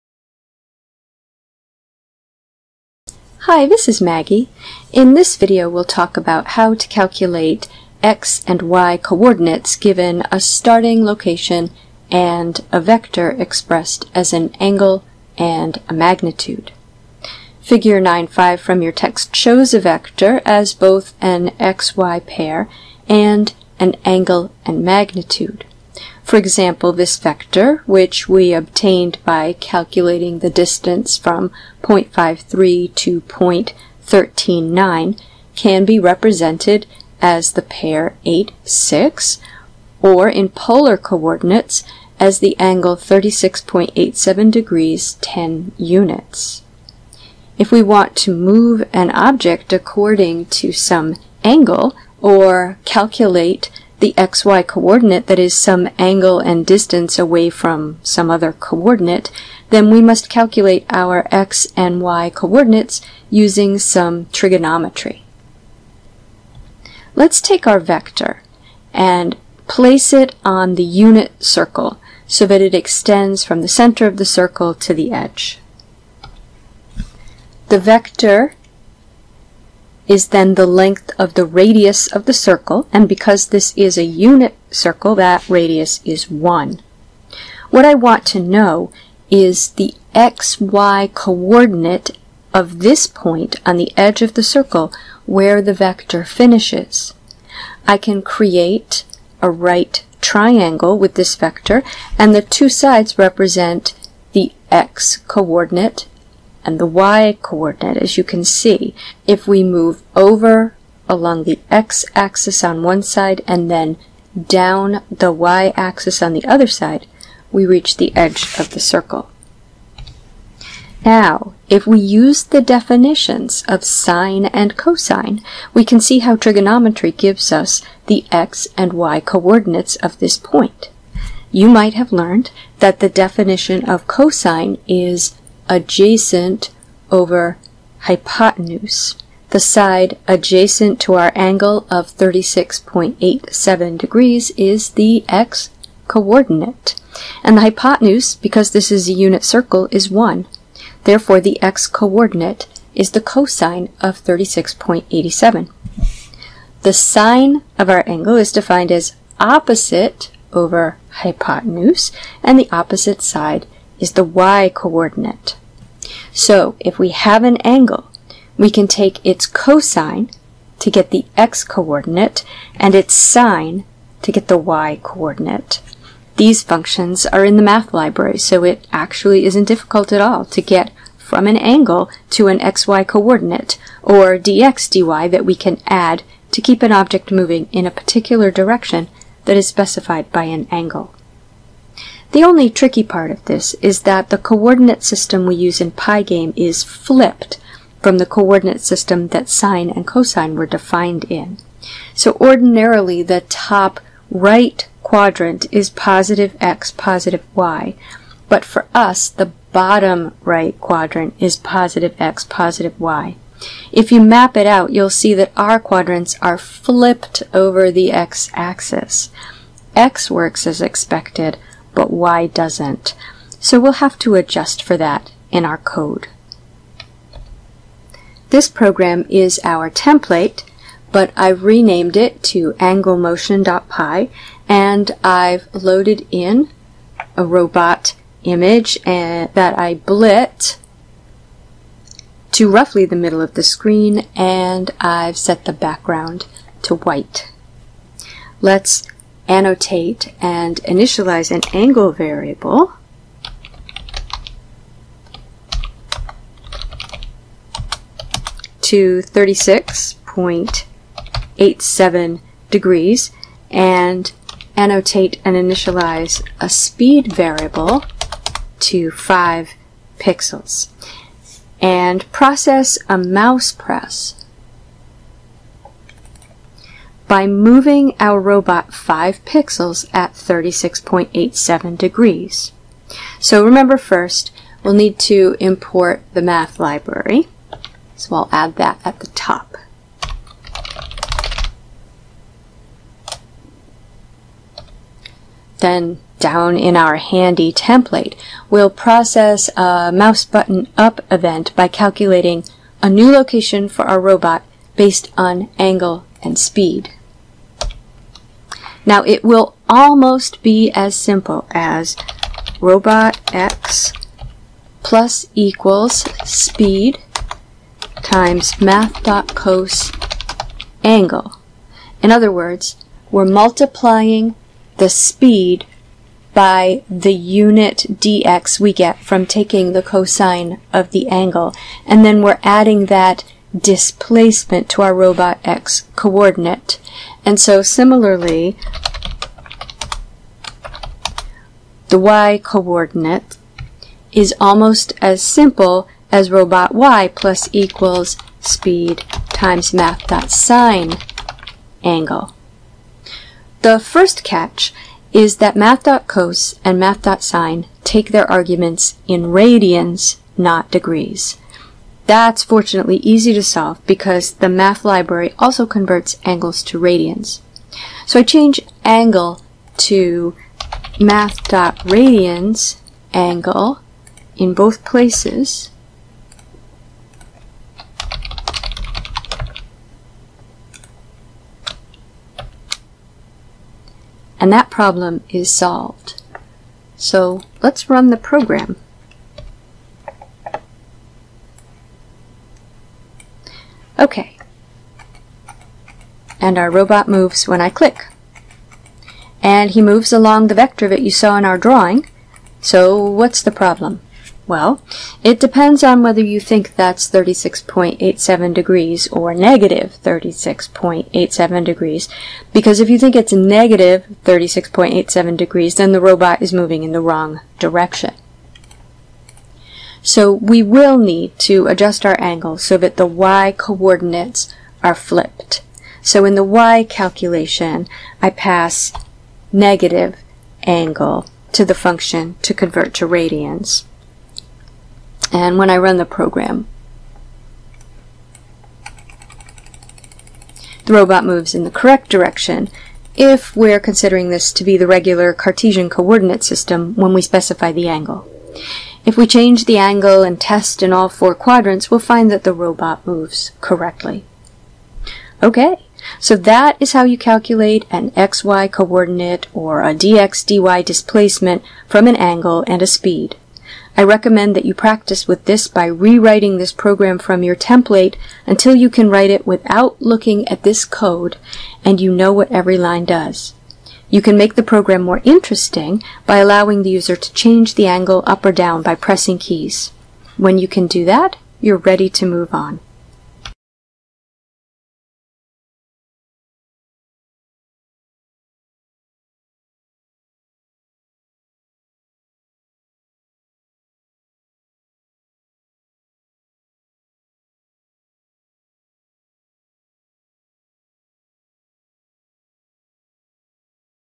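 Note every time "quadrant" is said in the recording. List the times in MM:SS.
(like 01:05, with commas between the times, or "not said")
03:25, 03:30, 03:35, 07:31.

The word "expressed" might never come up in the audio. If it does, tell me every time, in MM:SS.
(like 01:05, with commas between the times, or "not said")
00:13.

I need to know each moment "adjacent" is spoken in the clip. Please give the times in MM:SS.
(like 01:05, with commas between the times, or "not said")
02:15, 02:20.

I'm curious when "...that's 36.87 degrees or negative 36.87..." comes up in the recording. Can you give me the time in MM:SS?
06:46.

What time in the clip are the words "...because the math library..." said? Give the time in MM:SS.
06:04.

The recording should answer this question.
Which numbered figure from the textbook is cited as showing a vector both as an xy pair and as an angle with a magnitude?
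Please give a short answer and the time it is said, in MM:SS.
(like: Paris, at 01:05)
Figure 9.5, at 00:17.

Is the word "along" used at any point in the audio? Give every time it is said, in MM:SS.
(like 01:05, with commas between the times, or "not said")
01:51, 06:40.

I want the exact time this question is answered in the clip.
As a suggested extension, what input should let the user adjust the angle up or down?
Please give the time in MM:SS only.
07:59.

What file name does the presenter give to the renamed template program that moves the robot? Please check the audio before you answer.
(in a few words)
anglemotion.py.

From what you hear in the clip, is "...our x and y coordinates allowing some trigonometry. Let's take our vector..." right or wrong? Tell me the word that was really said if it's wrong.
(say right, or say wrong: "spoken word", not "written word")
wrong: "using", not "allowing".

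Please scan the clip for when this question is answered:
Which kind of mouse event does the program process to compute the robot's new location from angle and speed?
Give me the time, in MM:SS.
05:00.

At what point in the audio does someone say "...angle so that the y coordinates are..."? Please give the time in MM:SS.
07:02.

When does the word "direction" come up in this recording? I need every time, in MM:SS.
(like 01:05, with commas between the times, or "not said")
03:08, 06:57, 07:22.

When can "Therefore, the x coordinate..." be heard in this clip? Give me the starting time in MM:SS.
02:31.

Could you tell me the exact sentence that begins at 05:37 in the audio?
And so similarly, the y coordinate is almost as simple as robot y plus equals speed times math dot sine angle.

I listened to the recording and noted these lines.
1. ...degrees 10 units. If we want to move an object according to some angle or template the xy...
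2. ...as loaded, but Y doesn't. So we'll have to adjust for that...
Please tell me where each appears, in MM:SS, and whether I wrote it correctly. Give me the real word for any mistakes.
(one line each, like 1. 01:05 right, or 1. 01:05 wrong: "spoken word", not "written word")
1. 00:44 wrong: "calculate", not "template"
2. 03:40 wrong: "expected", not "loaded".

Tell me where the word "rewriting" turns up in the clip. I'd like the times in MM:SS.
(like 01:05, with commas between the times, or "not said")
07:46.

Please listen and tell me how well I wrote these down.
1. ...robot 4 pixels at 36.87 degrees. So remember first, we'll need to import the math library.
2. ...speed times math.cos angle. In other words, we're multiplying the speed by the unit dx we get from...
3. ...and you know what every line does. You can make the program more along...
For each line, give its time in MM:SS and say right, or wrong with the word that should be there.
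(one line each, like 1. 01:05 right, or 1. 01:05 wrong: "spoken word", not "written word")
1. 04:38 wrong: "5", not "4"
2. 05:16 right
3. 07:52 wrong: "interesting", not "along".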